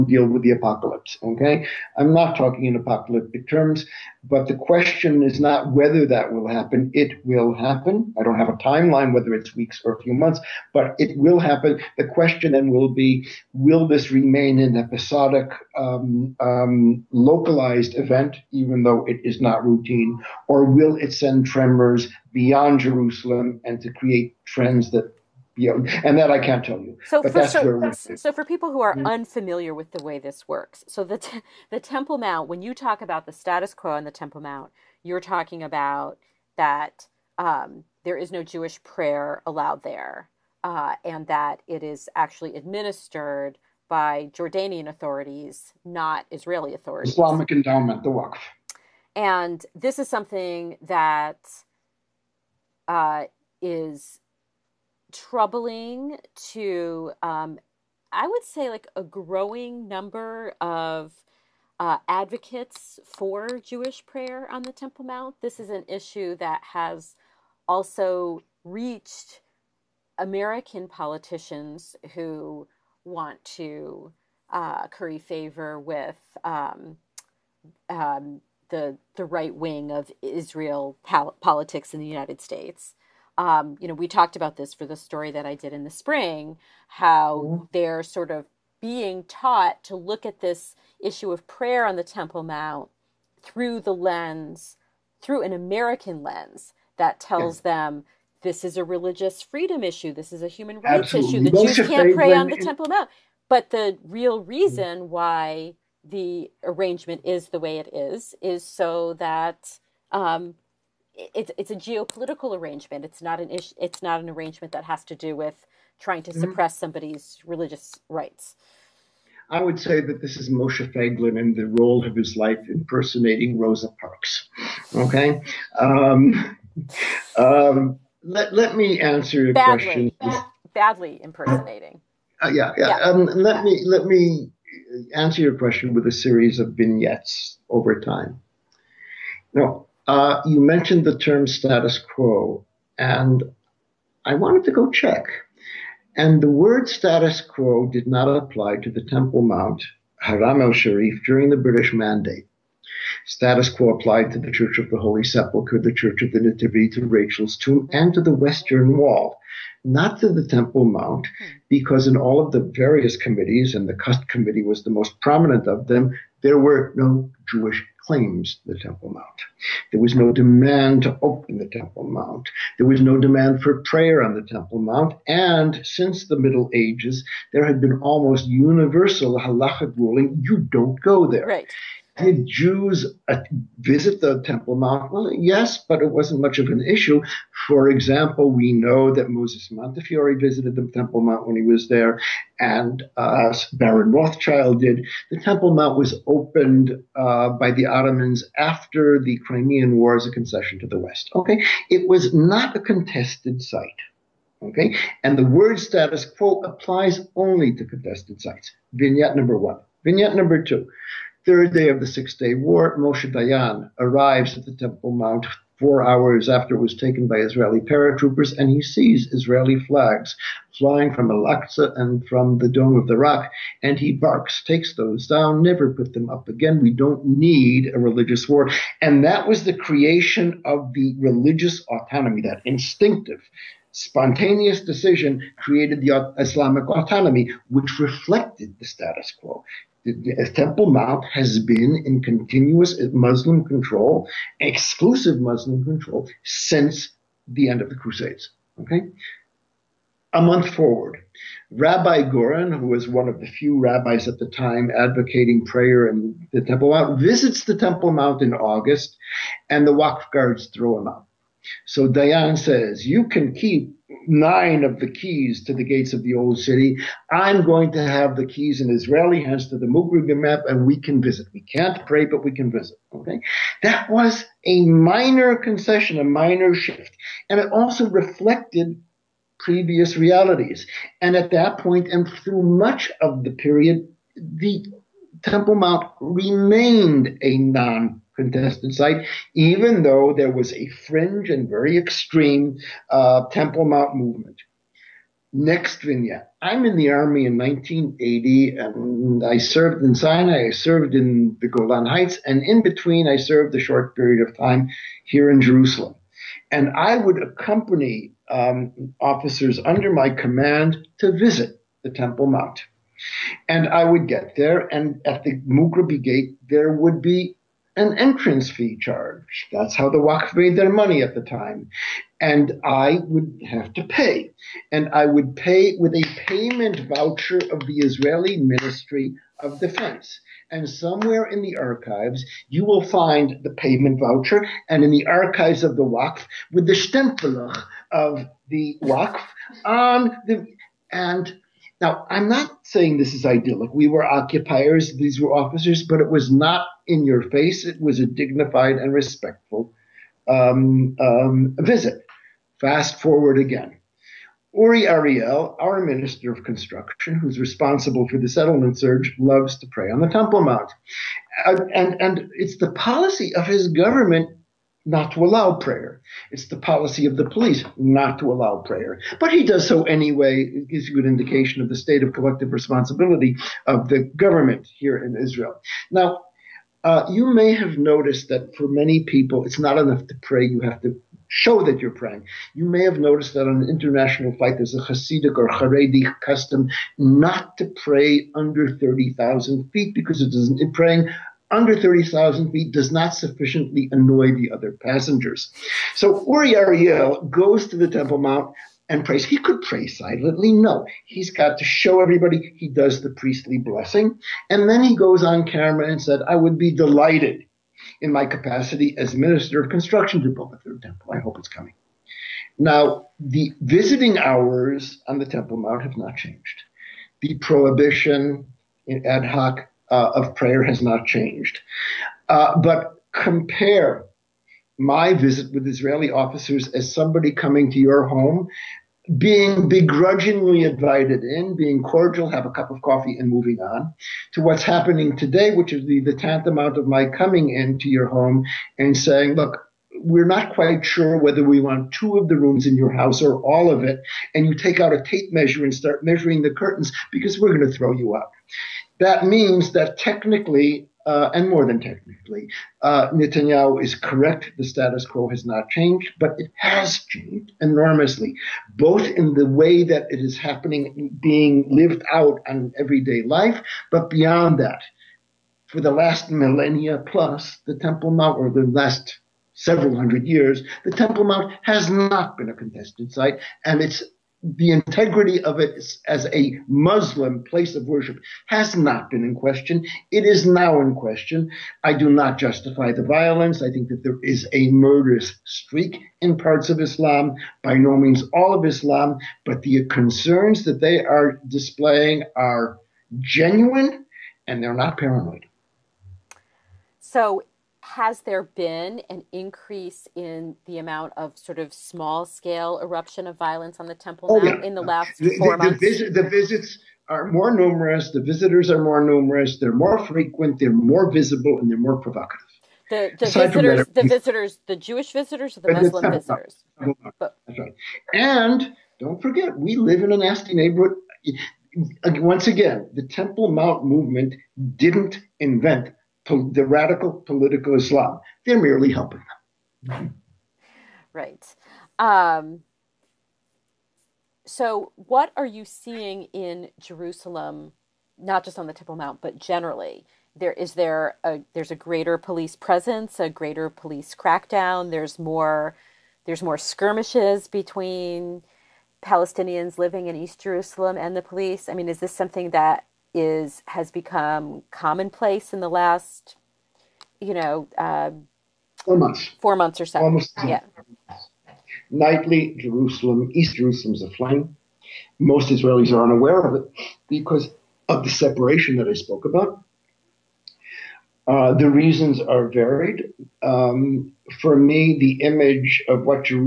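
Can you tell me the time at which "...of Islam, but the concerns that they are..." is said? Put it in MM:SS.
08:08.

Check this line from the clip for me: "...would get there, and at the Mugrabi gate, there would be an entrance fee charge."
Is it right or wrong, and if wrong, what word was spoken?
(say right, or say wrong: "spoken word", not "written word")
right.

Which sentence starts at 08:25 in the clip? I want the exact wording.
The, visit, the visits are more numerous, the visitors are more numerous, they're more frequent, they're more visible, and they're more provocative.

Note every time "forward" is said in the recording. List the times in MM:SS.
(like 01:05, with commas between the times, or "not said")
04:10, 05:53.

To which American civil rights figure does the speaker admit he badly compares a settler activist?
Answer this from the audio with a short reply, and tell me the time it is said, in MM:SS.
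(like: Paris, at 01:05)
Rosa Parks, at 02:03.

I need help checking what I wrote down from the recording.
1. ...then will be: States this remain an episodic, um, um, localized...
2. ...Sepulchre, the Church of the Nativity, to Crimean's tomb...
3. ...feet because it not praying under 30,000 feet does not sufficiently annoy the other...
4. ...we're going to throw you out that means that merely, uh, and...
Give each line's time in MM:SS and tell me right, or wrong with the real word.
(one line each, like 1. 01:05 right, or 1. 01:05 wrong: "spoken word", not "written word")
1. 00:12 wrong: "Will", not "States"
2. 02:35 wrong: "Rachel", not "Crimean"
3. 06:29 right
4. 07:27 wrong: "technically", not "merely".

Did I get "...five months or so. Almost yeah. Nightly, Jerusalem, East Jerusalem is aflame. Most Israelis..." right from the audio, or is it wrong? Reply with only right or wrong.
wrong.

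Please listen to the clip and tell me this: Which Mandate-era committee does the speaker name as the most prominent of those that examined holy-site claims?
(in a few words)
Cust Committee.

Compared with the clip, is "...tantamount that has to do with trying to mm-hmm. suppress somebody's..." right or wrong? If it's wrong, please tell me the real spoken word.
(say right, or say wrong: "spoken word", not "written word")
wrong: "arrangement", not "tantamount".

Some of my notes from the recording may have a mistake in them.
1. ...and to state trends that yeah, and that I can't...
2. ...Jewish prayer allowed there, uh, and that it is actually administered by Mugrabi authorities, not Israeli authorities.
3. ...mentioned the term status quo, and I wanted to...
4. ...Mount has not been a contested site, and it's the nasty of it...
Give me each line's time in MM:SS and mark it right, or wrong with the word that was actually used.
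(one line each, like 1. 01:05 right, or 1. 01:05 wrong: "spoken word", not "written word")
1. 00:23 wrong: "create", not "state"
2. 00:38 wrong: "Jordanian", not "Mugrabi"
3. 02:20 right
4. 07:51 wrong: "integrity", not "nasty".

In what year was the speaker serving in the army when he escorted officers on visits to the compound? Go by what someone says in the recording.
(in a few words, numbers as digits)
1980.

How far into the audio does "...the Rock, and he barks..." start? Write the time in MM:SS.
03:43.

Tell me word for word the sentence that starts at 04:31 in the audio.
We can't pray, but we can visit.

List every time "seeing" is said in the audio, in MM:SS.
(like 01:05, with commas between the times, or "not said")
08:55.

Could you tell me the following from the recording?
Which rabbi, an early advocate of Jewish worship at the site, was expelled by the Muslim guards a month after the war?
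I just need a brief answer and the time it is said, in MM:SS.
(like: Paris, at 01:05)
Rabbi Goren, at 04:11.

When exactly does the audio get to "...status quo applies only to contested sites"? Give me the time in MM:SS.
03:25.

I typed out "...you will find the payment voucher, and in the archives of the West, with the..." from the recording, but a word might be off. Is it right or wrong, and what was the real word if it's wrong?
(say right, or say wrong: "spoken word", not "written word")
wrong: "Waqf", not "West".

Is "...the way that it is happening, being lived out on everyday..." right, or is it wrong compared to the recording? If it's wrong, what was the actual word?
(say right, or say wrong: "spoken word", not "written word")
right.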